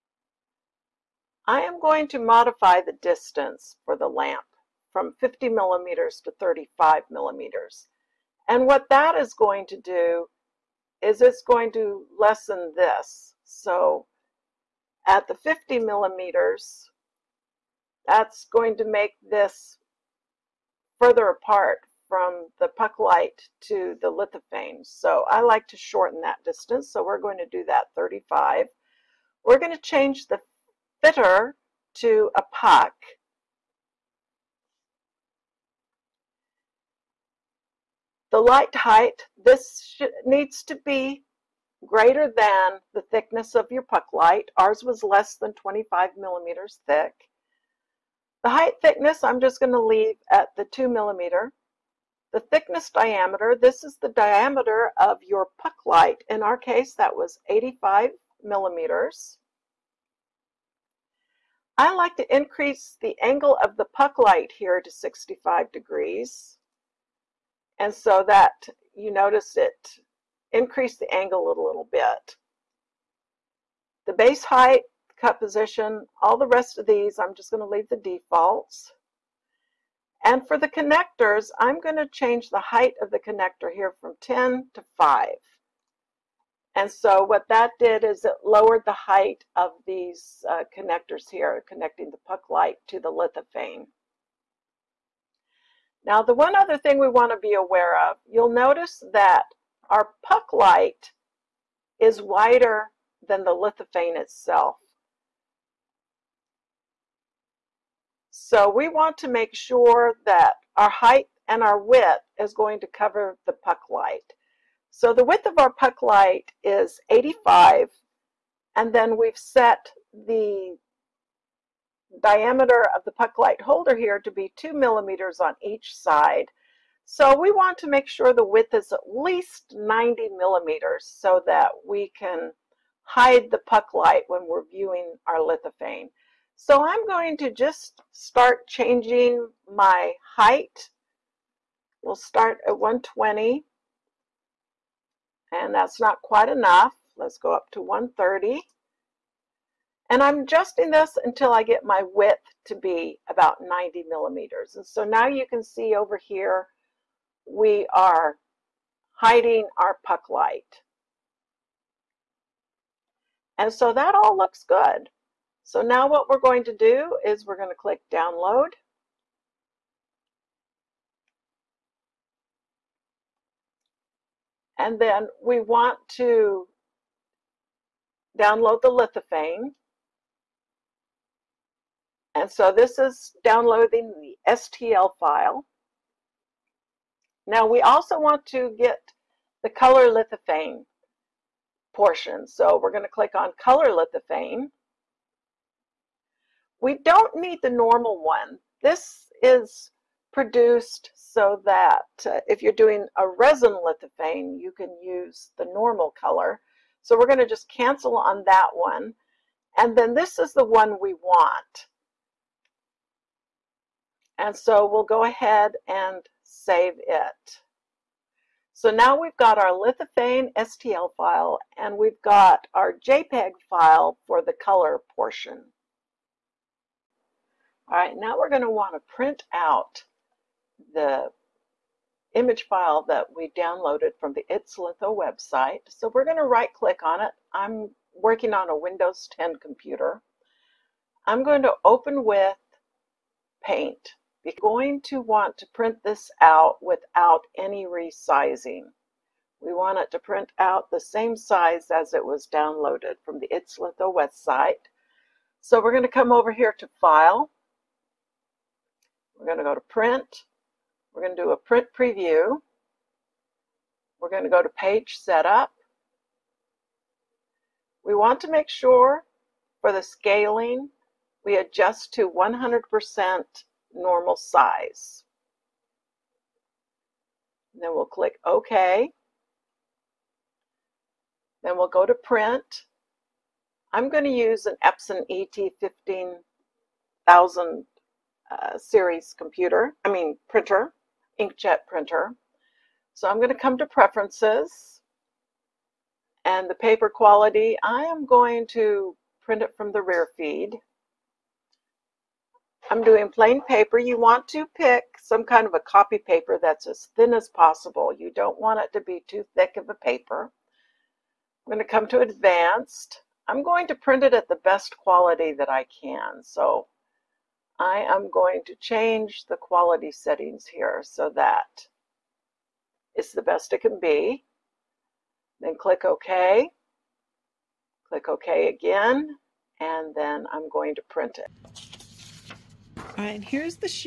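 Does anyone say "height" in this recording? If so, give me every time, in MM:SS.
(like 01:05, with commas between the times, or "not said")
00:38, 00:48, 01:14, 01:22, 01:28, 01:50, 02:20.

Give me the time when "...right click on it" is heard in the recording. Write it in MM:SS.
03:56.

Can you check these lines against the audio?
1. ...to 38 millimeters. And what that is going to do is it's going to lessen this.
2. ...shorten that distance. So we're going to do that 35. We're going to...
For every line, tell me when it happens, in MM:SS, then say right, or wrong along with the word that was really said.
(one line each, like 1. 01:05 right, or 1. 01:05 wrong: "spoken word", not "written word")
1. 00:06 wrong: "35", not "38"
2. 00:25 right.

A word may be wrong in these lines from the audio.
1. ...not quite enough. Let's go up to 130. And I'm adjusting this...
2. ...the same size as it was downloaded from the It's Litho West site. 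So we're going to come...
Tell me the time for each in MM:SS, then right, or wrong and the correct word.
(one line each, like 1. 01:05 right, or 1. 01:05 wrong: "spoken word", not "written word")
1. 02:25 right
2. 04:10 right.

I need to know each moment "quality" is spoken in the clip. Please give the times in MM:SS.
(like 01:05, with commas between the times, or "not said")
04:57, 05:14, 05:19.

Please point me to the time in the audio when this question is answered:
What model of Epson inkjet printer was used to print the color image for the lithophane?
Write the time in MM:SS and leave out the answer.
04:47.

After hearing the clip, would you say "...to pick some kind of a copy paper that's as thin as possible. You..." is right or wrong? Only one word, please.
right.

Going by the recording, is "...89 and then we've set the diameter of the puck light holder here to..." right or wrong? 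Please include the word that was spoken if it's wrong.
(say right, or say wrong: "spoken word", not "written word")
wrong: "85", not "89".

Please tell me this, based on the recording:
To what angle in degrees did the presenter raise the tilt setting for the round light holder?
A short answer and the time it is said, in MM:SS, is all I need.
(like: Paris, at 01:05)
65 degrees, at 01:04.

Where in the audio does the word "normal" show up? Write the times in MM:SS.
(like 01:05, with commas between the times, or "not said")
03:17, 03:25, 04:33.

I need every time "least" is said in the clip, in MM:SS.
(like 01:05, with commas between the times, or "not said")
02:09.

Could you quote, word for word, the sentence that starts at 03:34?
And so we'll go ahead and save it.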